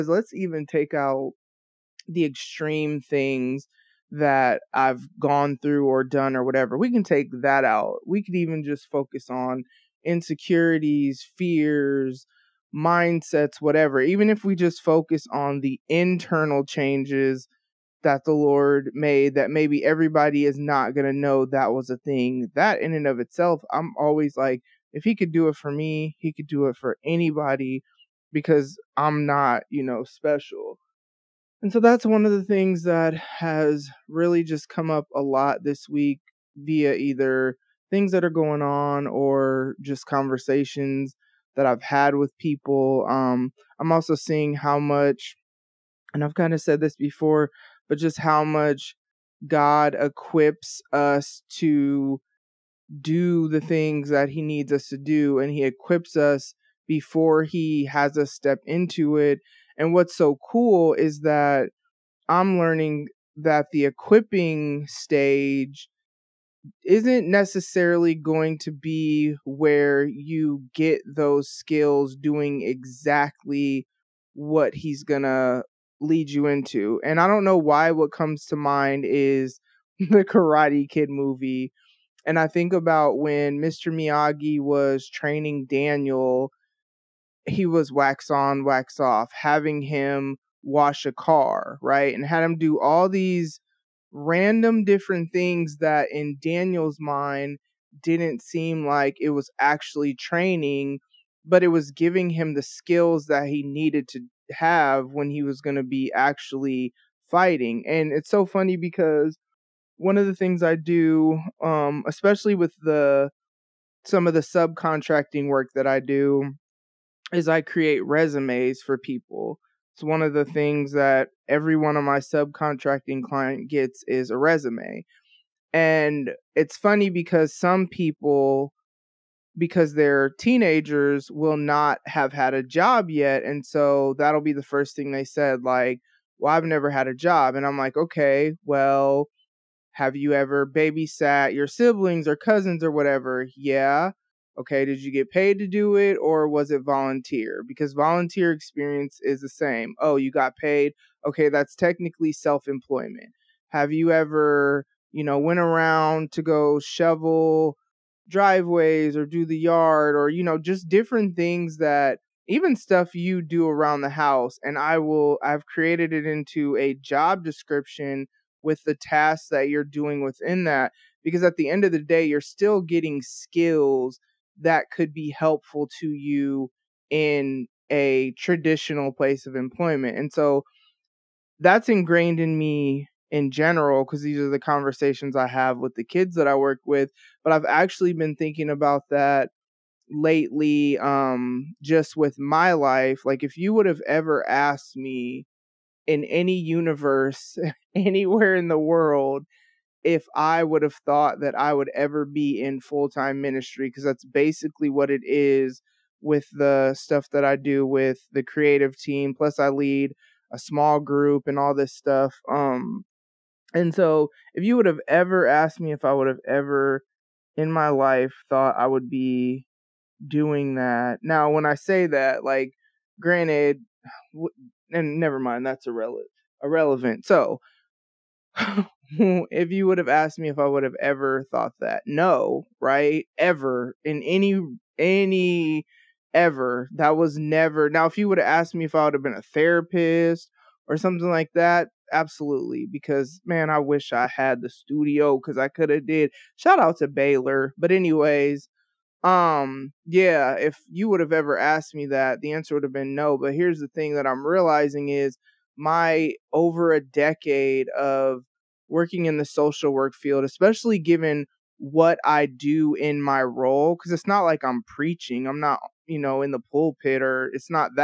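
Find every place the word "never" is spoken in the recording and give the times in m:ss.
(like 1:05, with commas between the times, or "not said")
2:16, 3:45, 3:57.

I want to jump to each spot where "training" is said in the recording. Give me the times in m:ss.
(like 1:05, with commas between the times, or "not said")
1:25, 1:40.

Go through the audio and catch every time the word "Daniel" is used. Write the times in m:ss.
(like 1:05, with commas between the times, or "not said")
1:25, 1:36.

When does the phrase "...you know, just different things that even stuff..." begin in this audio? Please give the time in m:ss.
2:40.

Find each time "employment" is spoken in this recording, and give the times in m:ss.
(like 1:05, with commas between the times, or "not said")
2:32, 2:59.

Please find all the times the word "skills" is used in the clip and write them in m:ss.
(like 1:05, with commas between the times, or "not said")
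1:11, 1:42, 2:53.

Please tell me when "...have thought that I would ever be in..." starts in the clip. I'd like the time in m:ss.
3:20.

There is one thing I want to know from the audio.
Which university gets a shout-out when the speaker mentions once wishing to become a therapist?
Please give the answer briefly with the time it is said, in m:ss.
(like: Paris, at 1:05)
Baylor, at 4:07.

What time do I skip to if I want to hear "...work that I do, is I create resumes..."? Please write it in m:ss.
1:55.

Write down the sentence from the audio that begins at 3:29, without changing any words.
Plus, I lead a small group and all this stuff.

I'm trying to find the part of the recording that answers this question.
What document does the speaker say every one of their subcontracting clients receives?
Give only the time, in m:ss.
2:04.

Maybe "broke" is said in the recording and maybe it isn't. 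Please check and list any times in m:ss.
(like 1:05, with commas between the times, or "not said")
not said.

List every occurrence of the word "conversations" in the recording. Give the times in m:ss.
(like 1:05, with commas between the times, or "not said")
0:40, 3:04.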